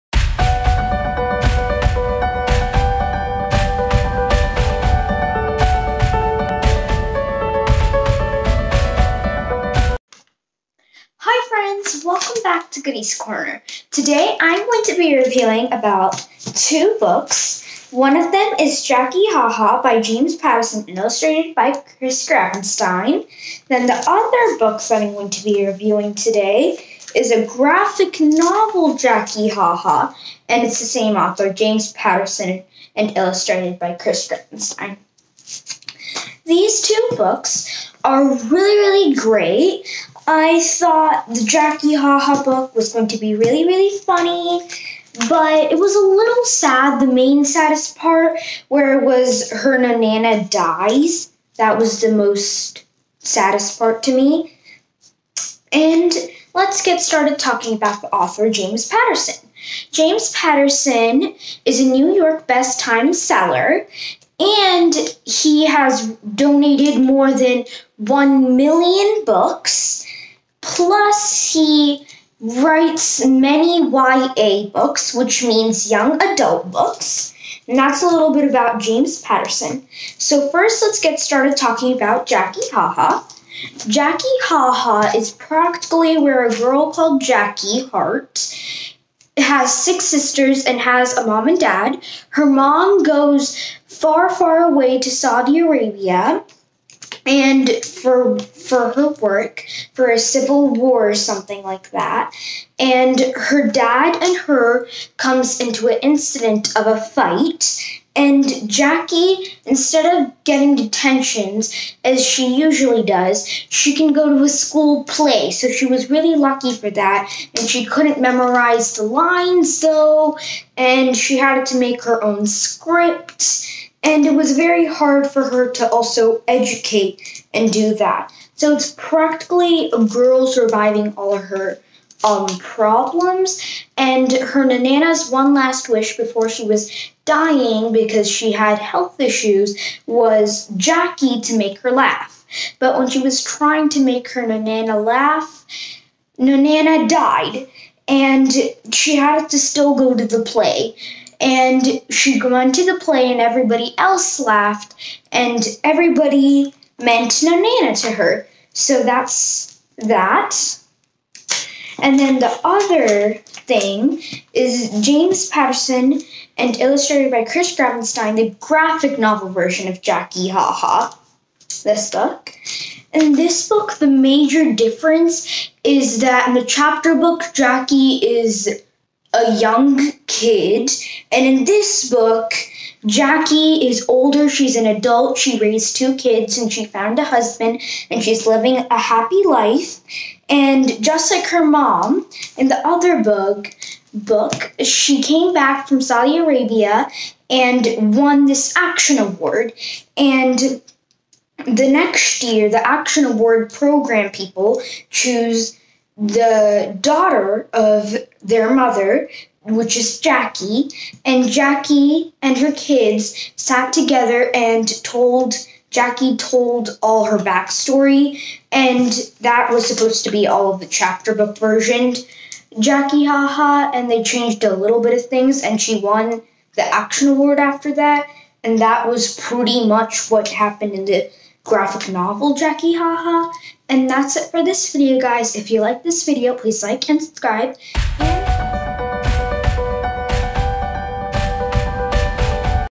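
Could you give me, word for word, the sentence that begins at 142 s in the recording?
But when she was trying to make her Nanana laugh, Nanana died.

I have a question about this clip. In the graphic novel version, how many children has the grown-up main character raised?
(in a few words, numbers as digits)
2.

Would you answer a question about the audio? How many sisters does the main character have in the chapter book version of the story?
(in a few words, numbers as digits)
6.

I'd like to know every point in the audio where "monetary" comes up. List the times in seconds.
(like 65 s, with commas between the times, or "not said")
not said.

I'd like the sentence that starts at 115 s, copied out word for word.
So she was really lucky for that.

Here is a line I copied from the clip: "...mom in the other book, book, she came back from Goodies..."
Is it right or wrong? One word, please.
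wrong.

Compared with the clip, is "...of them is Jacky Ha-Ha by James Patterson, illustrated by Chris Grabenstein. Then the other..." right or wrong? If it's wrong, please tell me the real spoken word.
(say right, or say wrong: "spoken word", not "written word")
right.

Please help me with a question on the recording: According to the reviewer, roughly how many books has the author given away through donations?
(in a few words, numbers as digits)
More than 1 million.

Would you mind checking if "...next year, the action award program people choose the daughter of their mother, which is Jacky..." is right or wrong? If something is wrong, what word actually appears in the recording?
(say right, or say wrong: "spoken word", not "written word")
right.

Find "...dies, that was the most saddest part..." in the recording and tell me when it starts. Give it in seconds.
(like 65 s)
50 s.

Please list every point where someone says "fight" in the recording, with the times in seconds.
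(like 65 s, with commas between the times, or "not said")
106 s.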